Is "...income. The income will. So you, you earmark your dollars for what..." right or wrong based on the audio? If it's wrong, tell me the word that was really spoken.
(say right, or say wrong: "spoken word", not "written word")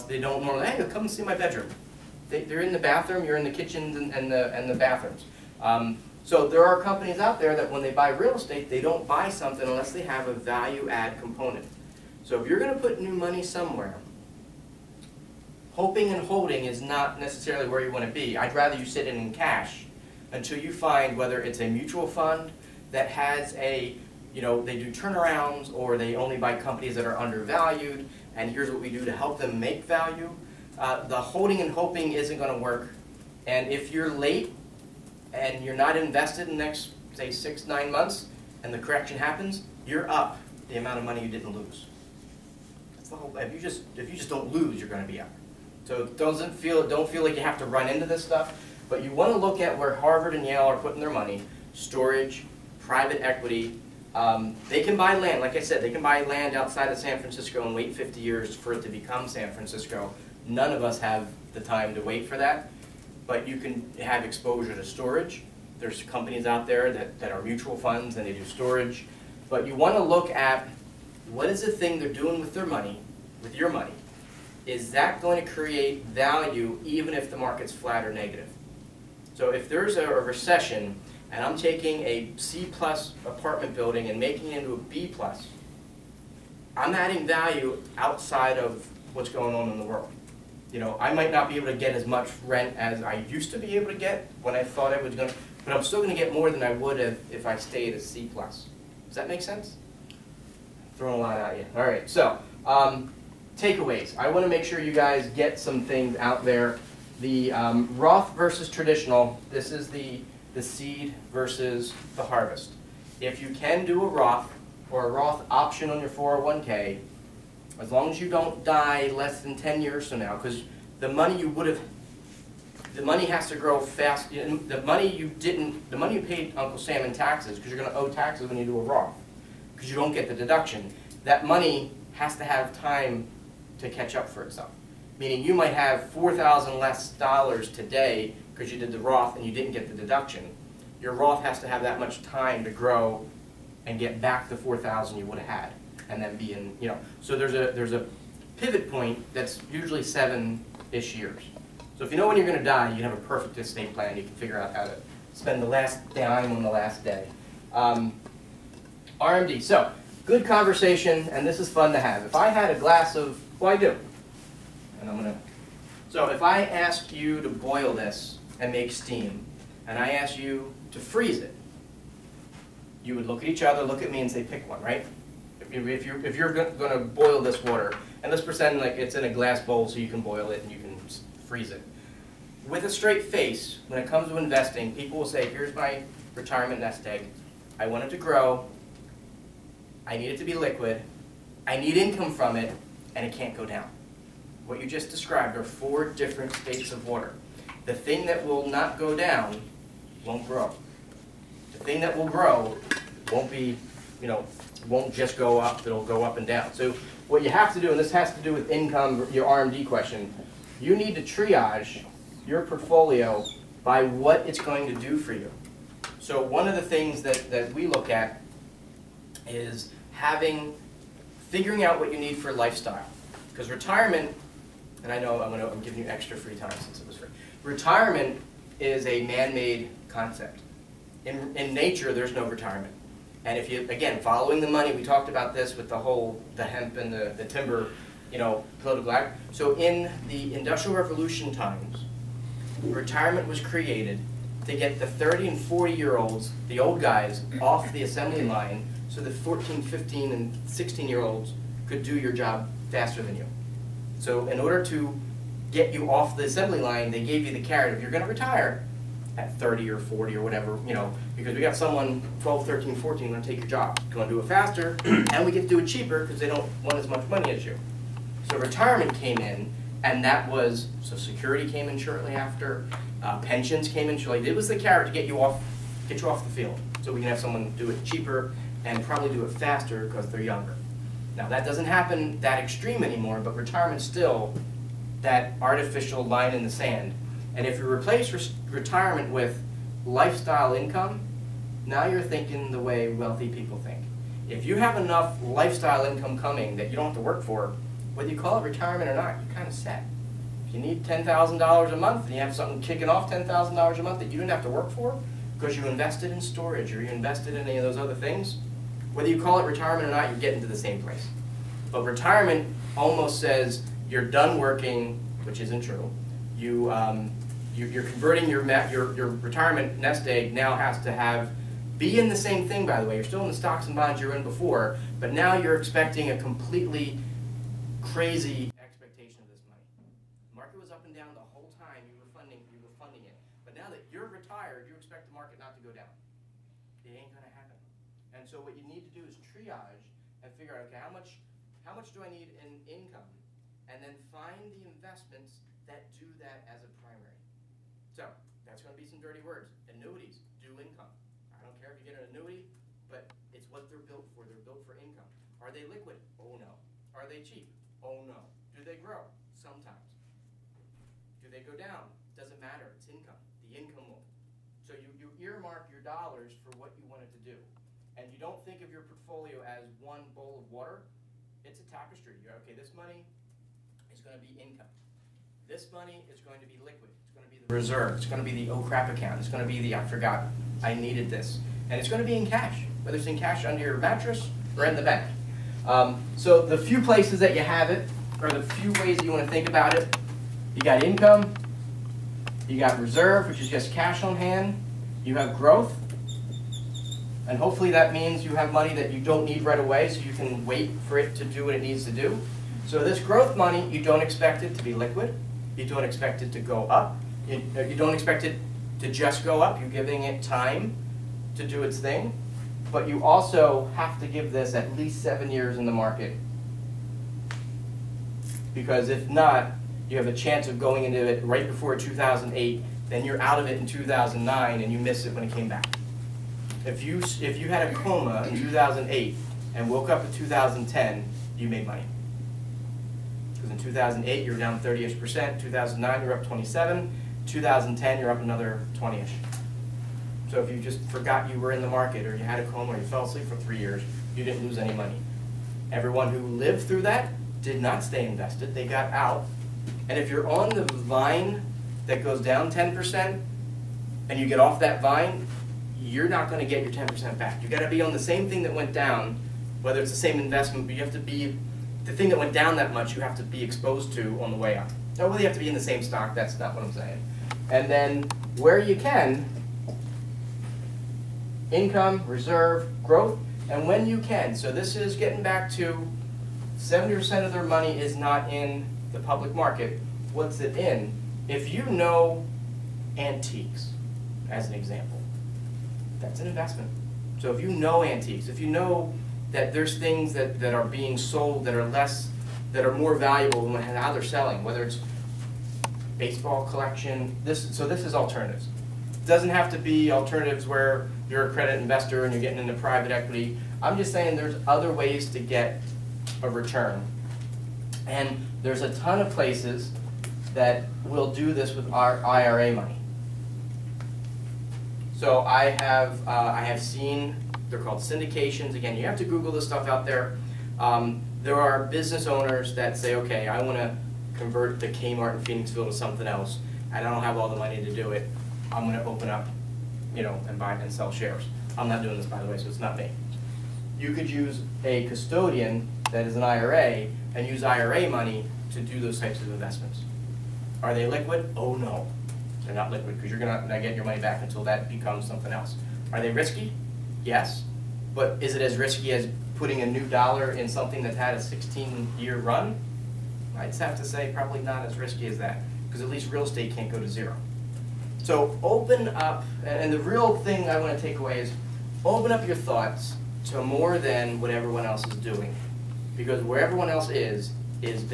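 right.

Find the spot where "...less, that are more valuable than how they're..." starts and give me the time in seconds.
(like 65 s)
491 s.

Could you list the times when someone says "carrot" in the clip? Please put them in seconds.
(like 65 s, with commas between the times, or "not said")
257 s, 274 s.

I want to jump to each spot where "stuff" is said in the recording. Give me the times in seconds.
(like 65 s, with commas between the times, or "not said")
48 s, 519 s.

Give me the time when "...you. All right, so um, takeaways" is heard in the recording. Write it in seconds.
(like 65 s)
101 s.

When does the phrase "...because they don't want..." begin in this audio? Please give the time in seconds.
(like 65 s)
266 s.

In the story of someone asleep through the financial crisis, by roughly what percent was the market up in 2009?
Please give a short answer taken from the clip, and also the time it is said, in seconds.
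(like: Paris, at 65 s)
27%, at 436 s.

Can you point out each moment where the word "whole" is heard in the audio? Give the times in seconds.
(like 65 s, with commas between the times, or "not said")
43 s, 235 s, 331 s.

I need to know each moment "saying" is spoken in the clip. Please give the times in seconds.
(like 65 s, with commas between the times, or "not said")
466 s, 504 s.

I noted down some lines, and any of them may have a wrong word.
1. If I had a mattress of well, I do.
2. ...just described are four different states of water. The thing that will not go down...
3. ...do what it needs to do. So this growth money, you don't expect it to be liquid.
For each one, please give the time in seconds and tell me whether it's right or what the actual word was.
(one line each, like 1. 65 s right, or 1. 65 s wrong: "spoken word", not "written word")
1. 162 s wrong: "glass", not "mattress"
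2. 194 s right
3. 401 s right.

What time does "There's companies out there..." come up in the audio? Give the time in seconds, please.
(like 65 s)
65 s.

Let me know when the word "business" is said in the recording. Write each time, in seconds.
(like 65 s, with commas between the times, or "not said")
521 s.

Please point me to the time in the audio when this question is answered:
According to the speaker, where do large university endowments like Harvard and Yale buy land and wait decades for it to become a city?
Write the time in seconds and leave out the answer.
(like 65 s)
56 s.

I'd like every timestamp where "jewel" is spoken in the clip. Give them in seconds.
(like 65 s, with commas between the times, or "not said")
not said.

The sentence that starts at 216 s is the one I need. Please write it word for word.
So one of the things that, that we look at is having figuring out what you need for lifestyle.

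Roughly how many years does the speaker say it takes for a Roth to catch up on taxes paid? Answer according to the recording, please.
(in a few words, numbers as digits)
7 years.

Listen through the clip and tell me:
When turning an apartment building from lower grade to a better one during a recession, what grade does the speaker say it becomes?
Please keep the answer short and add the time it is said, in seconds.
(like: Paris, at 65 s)
B plus, at 84 s.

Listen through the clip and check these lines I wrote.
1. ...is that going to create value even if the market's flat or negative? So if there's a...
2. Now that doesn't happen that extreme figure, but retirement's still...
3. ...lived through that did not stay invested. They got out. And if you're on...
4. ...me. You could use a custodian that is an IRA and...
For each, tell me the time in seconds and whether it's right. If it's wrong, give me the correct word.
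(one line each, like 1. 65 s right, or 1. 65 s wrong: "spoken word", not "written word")
1. 74 s right
2. 281 s wrong: "anymore", not "figure"
3. 446 s right
4. 532 s right.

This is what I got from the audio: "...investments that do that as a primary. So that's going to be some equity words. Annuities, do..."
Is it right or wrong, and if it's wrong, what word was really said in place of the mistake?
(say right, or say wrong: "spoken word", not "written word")
wrong: "dirty", not "equity".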